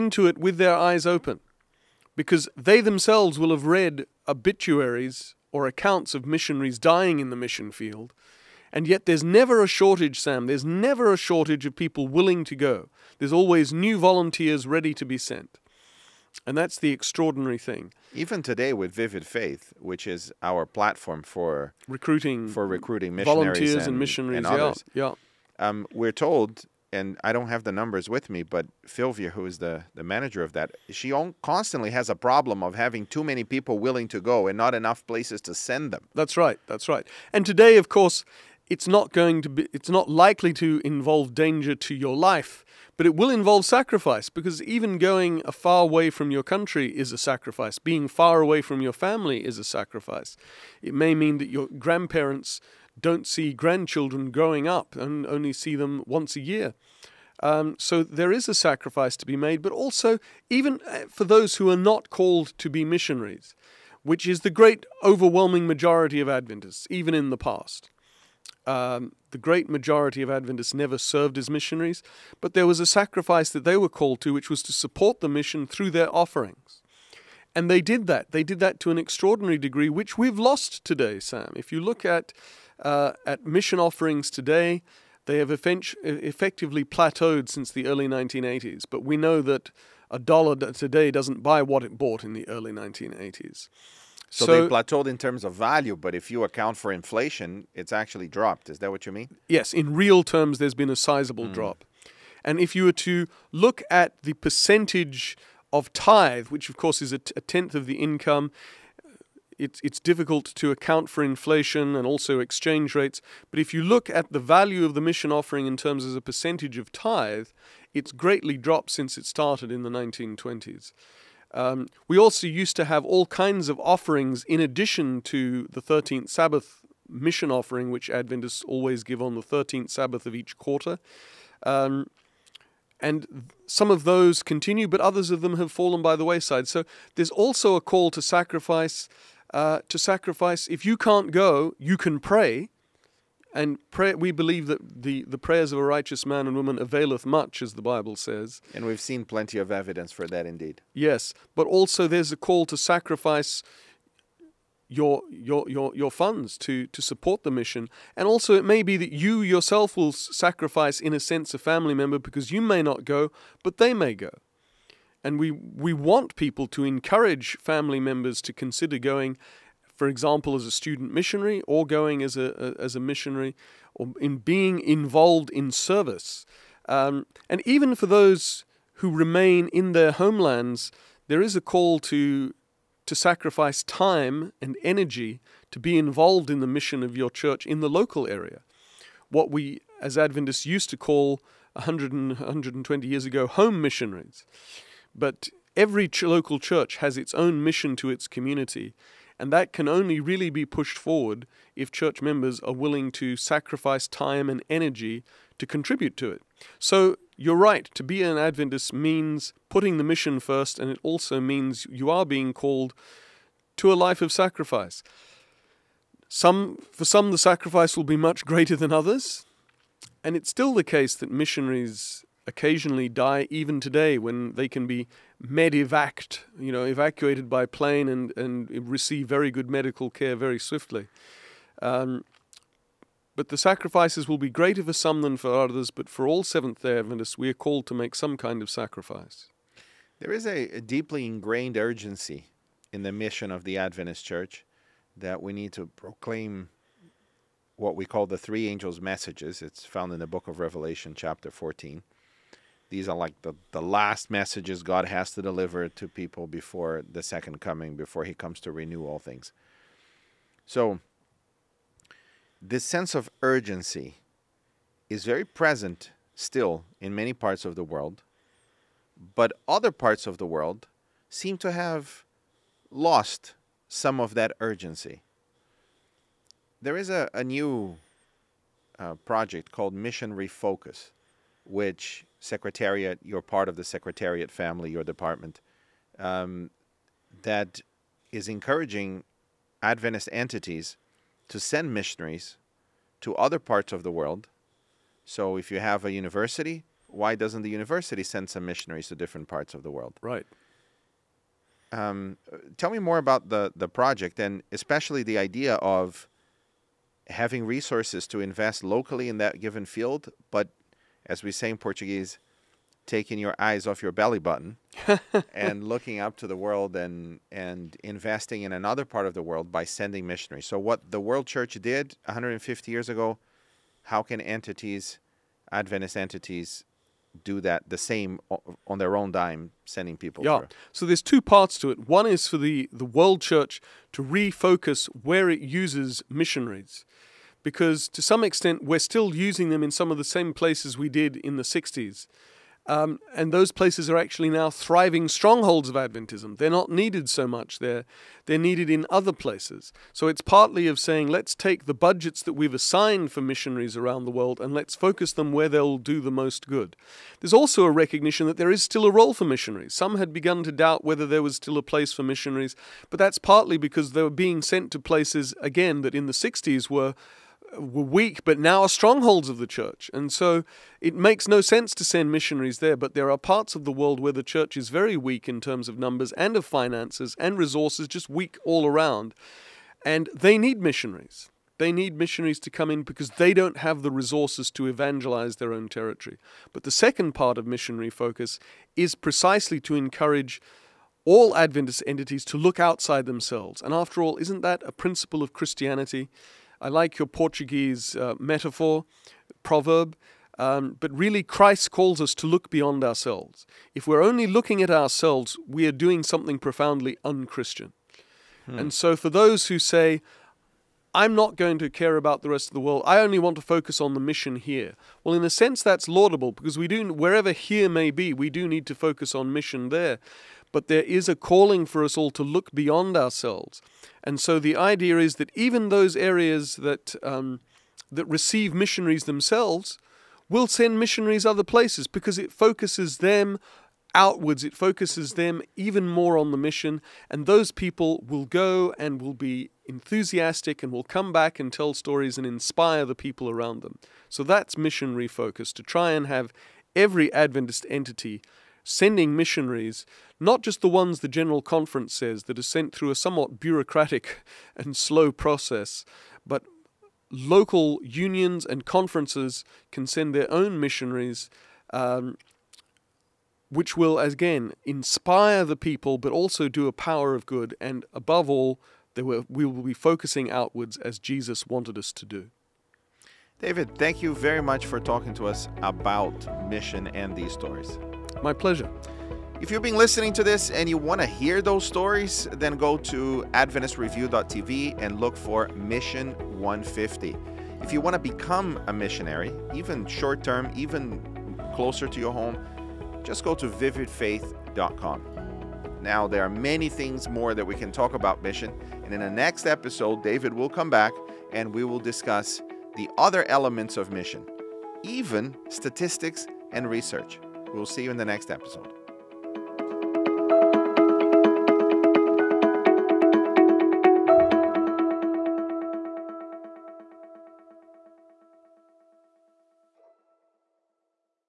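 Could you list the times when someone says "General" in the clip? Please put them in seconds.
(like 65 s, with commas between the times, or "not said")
451 s.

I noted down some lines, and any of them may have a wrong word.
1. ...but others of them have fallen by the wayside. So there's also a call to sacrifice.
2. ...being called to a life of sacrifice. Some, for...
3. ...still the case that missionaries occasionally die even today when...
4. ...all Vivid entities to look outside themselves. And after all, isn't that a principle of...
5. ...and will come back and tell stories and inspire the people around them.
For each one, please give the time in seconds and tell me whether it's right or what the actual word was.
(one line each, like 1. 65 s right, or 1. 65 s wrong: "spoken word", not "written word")
1. 134 s right
2. 212 s right
3. 220 s right
4. 391 s wrong: "Adventist", not "Vivid"
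5. 440 s right.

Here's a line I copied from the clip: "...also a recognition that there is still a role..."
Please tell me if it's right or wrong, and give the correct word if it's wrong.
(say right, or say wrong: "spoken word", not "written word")
right.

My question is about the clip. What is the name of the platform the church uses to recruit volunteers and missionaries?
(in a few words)
Vivid Faith.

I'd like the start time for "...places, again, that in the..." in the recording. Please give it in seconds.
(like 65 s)
364 s.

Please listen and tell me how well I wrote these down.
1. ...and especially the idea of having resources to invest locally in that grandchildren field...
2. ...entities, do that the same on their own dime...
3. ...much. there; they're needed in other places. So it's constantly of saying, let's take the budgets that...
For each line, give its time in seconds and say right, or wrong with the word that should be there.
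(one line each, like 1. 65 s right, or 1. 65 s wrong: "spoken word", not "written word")
1. 304 s wrong: "given", not "grandchildren"
2. 326 s right
3. 347 s wrong: "partly", not "constantly".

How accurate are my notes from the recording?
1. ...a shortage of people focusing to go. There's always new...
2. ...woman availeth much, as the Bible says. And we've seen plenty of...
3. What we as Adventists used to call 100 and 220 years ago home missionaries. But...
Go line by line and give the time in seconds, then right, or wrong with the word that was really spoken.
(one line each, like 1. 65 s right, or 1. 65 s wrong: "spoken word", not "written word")
1. 11 s wrong: "willing", not "focusing"
2. 146 s right
3. 189 s wrong: "120", not "220".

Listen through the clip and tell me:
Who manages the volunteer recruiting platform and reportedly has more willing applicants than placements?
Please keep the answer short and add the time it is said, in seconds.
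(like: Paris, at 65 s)
Filvia, at 28 s.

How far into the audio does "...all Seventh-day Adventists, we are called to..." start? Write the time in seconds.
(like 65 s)
236 s.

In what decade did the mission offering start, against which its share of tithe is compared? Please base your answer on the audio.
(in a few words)
1920s.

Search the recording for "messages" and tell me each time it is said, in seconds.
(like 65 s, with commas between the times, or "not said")
249 s, 254 s.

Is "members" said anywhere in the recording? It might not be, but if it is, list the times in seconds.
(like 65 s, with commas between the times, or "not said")
161 s, 167 s, 202 s.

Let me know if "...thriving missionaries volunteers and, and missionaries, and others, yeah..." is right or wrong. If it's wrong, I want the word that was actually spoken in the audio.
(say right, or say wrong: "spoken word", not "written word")
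wrong: "recruiting", not "thriving".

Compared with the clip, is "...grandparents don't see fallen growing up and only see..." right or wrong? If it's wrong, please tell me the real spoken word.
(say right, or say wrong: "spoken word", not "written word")
wrong: "grandchildren", not "fallen".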